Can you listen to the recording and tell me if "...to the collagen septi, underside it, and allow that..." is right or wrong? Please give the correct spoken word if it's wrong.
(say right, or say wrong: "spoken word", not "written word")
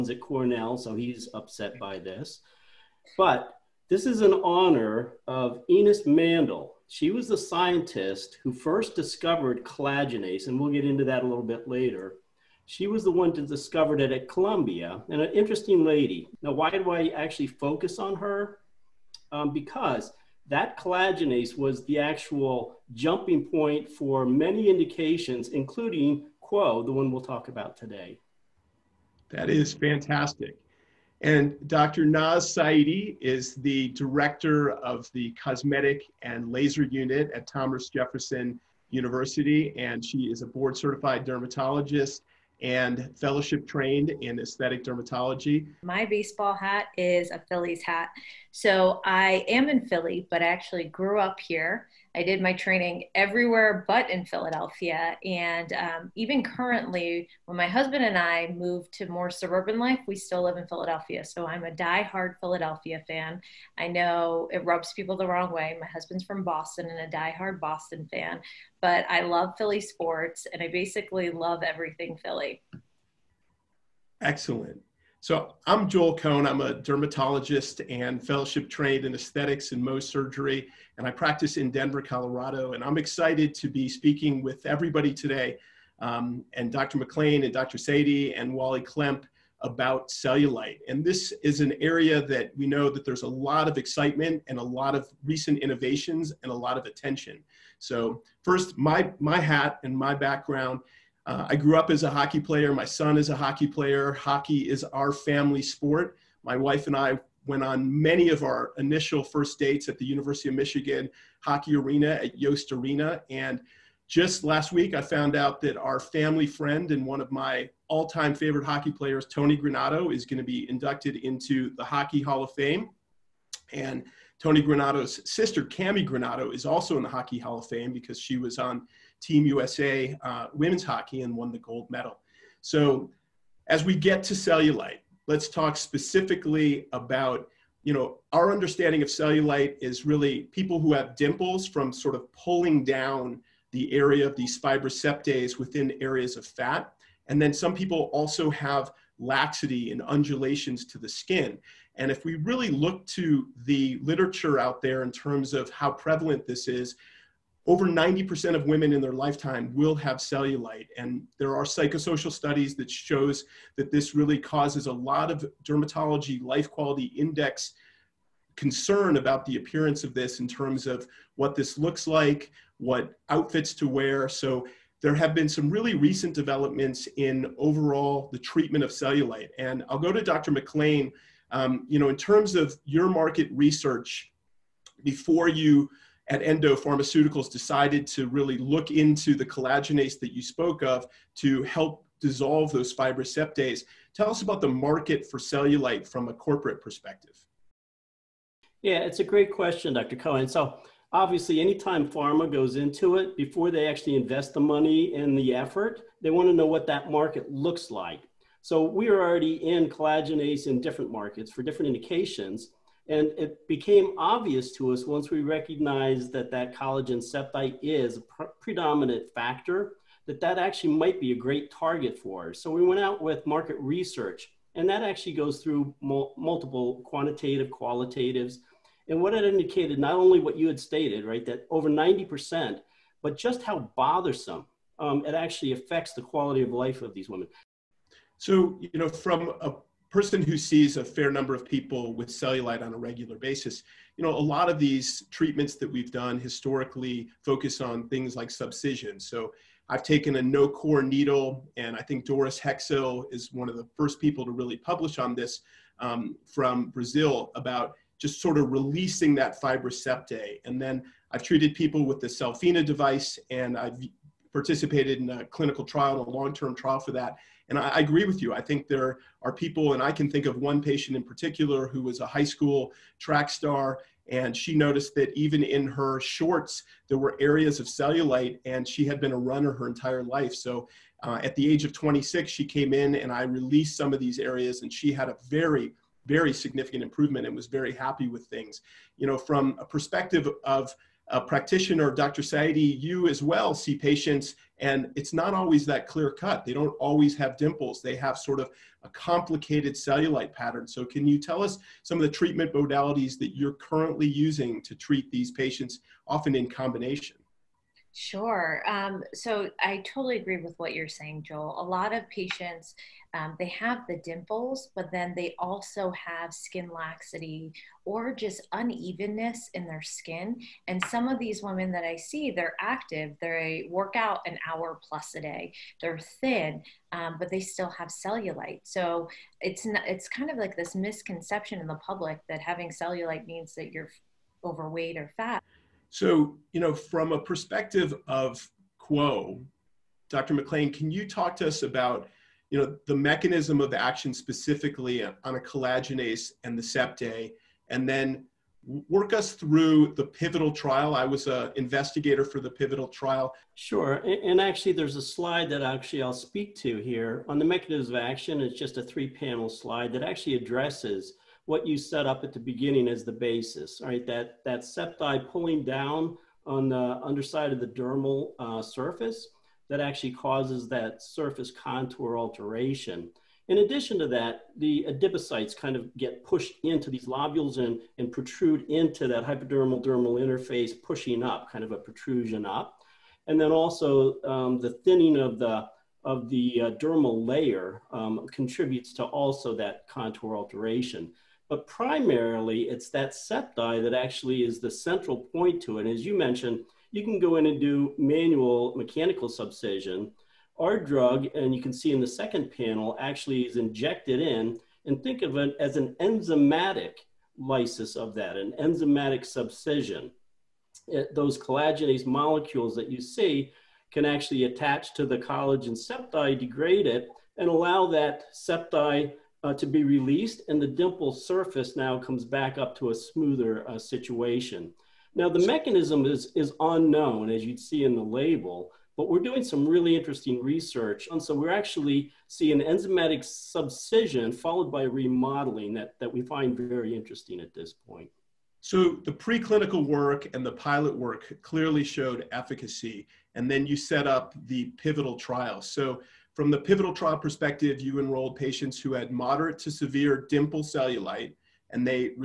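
wrong: "degrade", not "underside".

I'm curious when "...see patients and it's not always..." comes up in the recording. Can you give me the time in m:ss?
4:53.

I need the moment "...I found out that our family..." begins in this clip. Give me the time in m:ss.
1:54.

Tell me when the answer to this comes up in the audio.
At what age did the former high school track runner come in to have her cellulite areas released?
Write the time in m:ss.
4:41.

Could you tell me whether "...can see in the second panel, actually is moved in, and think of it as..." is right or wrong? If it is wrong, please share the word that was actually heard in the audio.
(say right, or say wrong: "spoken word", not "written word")
wrong: "injected", not "moved".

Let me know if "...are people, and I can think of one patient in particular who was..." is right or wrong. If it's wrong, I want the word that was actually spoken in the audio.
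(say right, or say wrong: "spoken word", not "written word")
right.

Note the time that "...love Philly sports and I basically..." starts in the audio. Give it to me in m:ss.
1:09.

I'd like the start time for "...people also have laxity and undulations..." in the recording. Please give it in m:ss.
2:27.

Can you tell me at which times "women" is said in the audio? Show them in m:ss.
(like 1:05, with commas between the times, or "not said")
2:10, 2:38, 3:57, 5:21.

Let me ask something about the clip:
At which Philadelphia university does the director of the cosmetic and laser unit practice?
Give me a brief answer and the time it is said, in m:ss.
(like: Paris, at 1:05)
Thomas Jefferson University, at 0:37.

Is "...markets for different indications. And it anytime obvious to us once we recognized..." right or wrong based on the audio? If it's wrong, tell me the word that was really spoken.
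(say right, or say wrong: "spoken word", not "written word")
wrong: "became", not "anytime".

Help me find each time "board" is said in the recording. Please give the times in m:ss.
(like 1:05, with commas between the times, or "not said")
0:40.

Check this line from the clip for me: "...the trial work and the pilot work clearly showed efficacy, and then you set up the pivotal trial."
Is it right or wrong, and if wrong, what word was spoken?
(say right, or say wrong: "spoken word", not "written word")
wrong: "preclinical", not "trial".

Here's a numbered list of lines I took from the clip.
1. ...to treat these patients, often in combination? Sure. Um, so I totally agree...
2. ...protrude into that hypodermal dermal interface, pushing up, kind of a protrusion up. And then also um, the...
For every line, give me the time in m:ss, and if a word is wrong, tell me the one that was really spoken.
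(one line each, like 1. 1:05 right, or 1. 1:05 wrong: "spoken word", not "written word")
1. 5:04 right
2. 6:18 right.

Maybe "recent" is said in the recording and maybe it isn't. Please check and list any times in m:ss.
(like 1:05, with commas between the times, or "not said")
1:35, 2:55.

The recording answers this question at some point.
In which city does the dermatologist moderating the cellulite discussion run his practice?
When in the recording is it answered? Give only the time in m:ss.
1:21.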